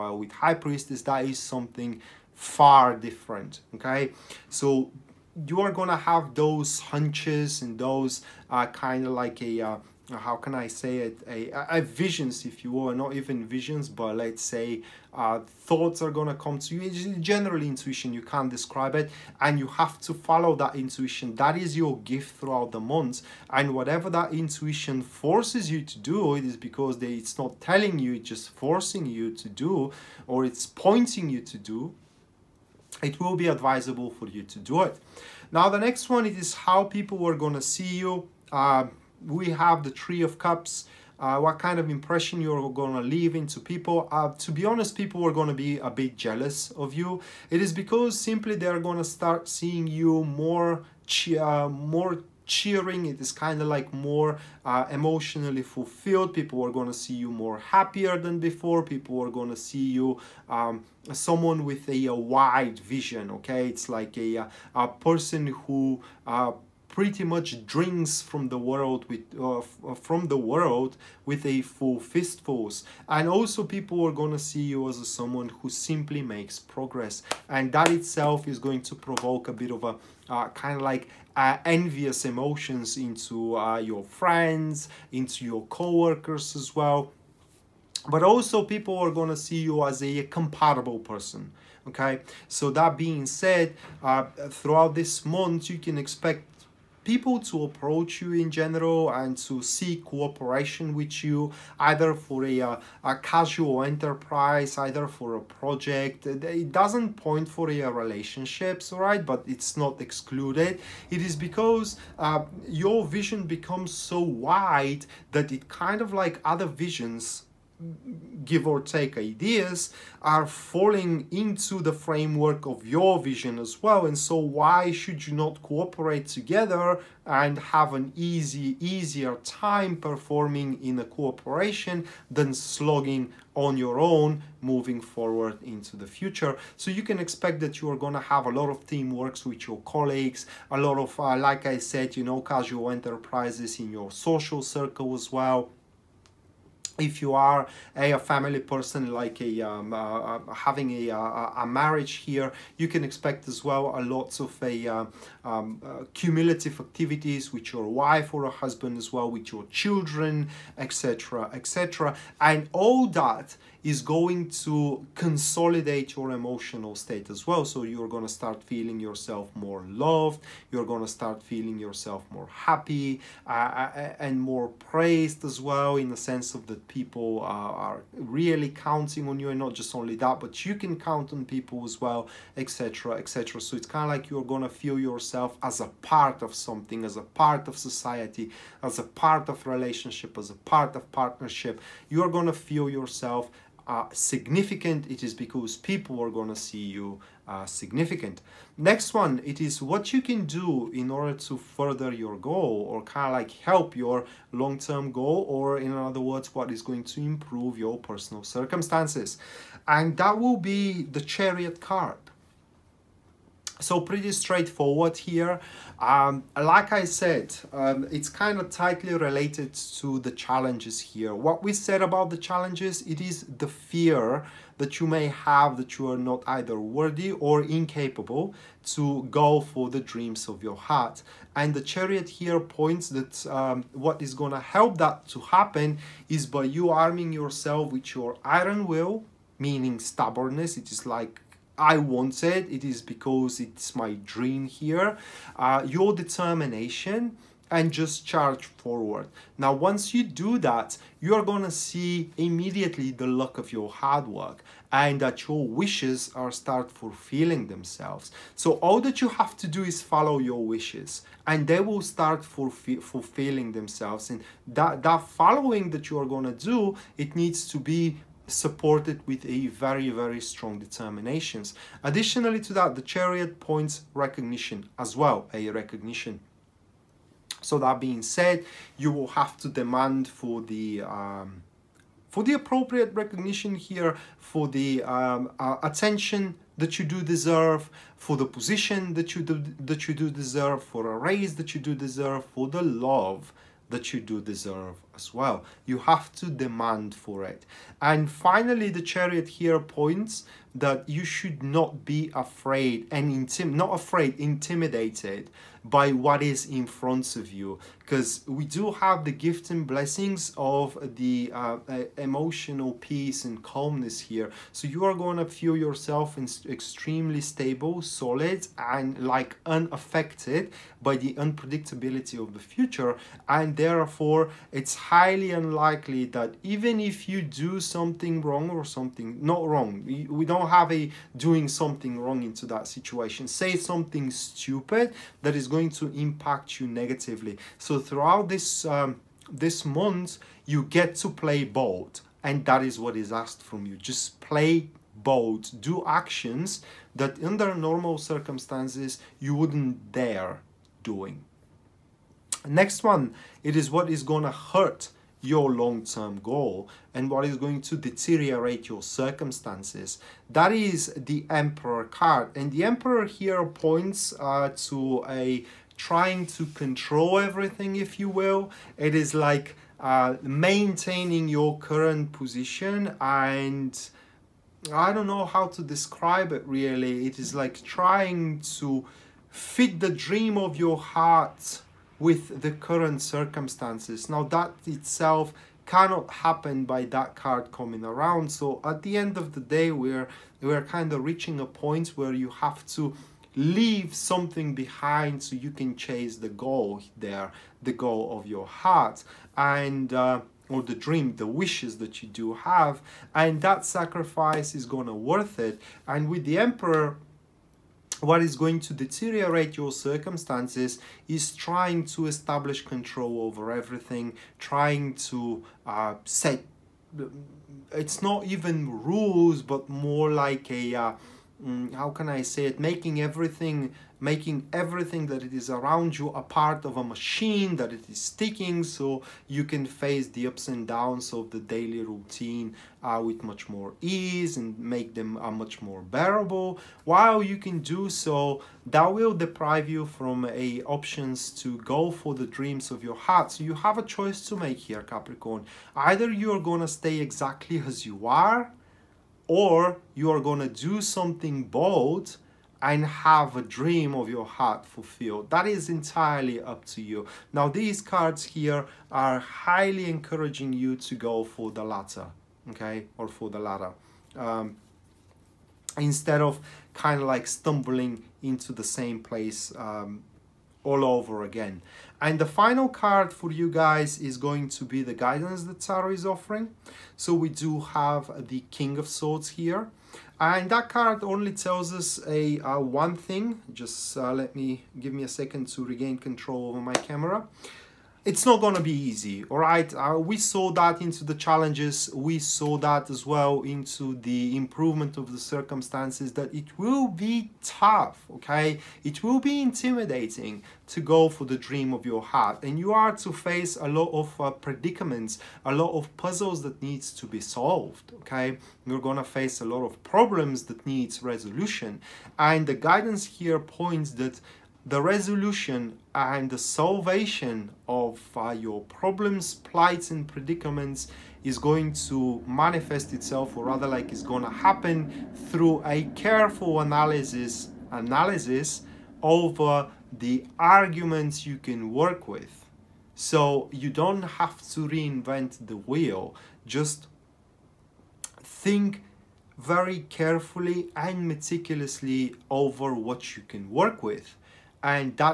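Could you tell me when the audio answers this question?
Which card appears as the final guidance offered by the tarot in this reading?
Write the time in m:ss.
7:58.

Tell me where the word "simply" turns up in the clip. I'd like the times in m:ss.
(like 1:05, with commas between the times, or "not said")
0:48, 1:15.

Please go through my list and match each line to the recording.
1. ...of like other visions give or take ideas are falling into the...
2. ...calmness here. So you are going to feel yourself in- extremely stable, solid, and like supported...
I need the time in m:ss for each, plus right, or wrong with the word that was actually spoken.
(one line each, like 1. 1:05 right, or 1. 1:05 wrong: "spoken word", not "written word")
1. 1:56 right
2. 5:13 wrong: "unaffected", not "supported".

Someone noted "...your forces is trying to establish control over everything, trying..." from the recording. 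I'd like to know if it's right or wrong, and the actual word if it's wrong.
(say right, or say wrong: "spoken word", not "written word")
wrong: "circumstances", not "forces".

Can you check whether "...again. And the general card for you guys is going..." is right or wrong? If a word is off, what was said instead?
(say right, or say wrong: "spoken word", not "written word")
wrong: "final", not "general".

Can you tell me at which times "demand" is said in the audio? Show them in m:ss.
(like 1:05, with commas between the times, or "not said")
4:39, 4:56.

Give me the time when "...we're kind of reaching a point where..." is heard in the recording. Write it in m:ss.
6:30.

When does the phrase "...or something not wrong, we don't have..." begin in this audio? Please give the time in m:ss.
5:28.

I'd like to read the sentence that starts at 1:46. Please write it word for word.
It doesn't point for your relationships, right?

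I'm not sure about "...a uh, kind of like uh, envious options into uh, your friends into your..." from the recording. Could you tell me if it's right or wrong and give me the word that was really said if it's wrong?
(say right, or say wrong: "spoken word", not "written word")
wrong: "emotions", not "options".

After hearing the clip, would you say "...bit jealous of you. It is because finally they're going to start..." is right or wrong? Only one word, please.
wrong.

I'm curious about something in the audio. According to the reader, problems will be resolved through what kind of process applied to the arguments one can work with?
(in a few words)
careful analysis.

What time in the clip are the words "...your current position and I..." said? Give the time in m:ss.
6:11.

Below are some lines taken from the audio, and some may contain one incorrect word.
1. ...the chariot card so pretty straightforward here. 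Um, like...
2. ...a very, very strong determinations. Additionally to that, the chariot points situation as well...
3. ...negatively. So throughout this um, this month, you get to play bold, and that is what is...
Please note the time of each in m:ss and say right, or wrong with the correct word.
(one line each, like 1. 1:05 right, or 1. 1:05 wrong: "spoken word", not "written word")
1. 3:31 right
2. 4:29 wrong: "recognition", not "situation"
3. 5:36 right.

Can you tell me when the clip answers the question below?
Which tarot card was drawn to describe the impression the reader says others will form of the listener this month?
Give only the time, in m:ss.
0:39.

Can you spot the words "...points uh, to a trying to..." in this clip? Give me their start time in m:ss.
6:03.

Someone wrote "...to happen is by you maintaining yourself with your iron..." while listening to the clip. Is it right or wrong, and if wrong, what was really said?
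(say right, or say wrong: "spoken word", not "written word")
wrong: "arming", not "maintaining".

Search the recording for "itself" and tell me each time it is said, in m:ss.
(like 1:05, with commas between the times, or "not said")
1:17, 6:24, 8:43.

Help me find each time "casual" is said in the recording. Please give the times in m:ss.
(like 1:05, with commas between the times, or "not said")
1:43, 2:22.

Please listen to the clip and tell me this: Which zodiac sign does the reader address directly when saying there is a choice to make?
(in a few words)
Capricorn.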